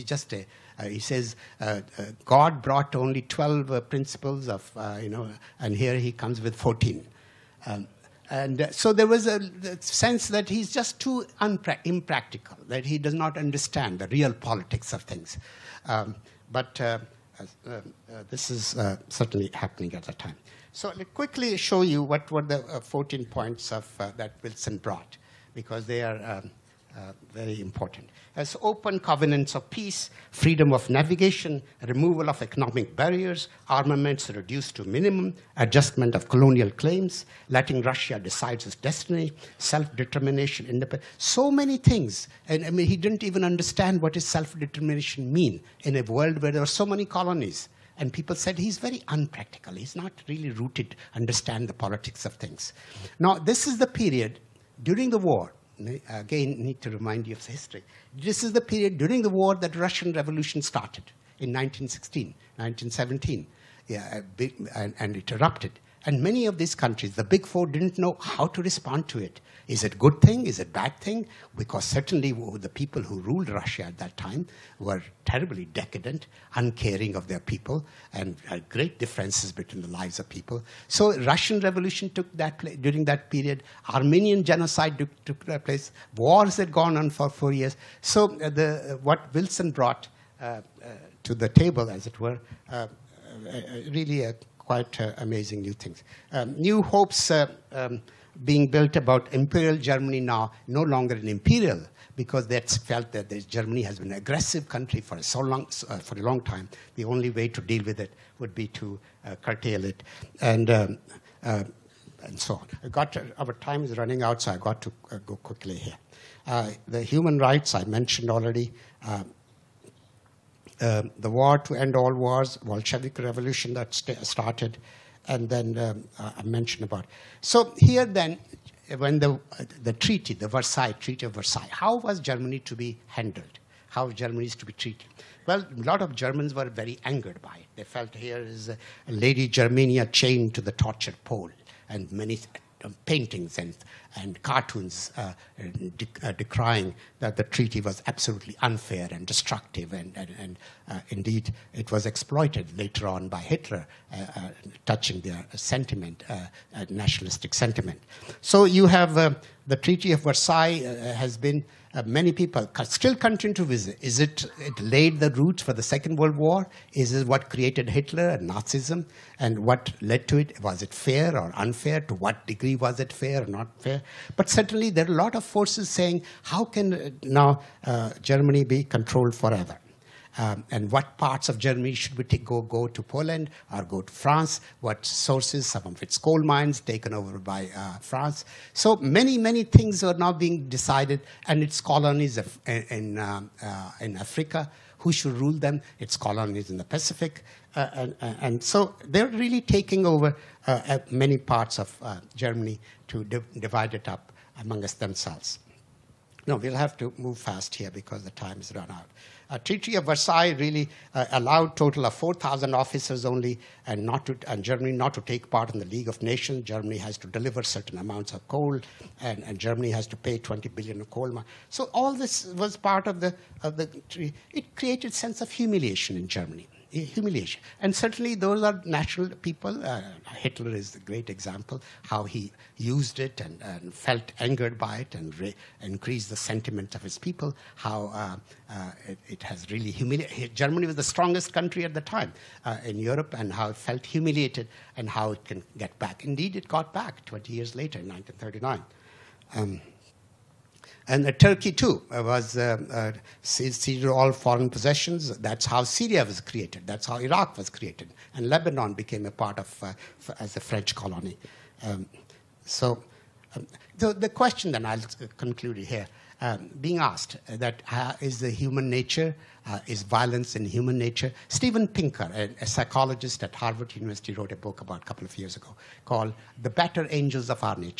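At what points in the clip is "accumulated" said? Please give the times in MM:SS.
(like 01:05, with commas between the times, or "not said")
not said.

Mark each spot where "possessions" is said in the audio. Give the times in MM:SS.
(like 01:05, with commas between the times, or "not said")
04:14.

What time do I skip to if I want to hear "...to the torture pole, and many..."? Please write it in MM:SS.
02:20.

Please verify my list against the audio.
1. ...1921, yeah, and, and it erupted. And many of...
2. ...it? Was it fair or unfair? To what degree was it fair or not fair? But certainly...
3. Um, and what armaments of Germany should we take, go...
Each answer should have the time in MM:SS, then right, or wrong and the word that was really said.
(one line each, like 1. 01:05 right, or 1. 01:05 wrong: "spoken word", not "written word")
1. 01:02 wrong: "1917", not "1921"
2. 02:50 right
3. 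03:00 wrong: "parts", not "armaments".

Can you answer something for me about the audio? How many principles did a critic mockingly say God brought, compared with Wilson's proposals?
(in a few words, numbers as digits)
12.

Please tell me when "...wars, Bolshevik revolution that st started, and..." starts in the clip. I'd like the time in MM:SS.
02:02.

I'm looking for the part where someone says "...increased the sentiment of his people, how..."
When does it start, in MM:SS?
03:55.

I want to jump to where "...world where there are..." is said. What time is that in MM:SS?
00:46.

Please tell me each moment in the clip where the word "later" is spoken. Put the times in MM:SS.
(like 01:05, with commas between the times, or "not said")
02:32, 04:07.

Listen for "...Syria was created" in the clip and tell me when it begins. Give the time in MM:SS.
04:15.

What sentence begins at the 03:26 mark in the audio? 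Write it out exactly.
No, we'll have to move fast here because the time has run out.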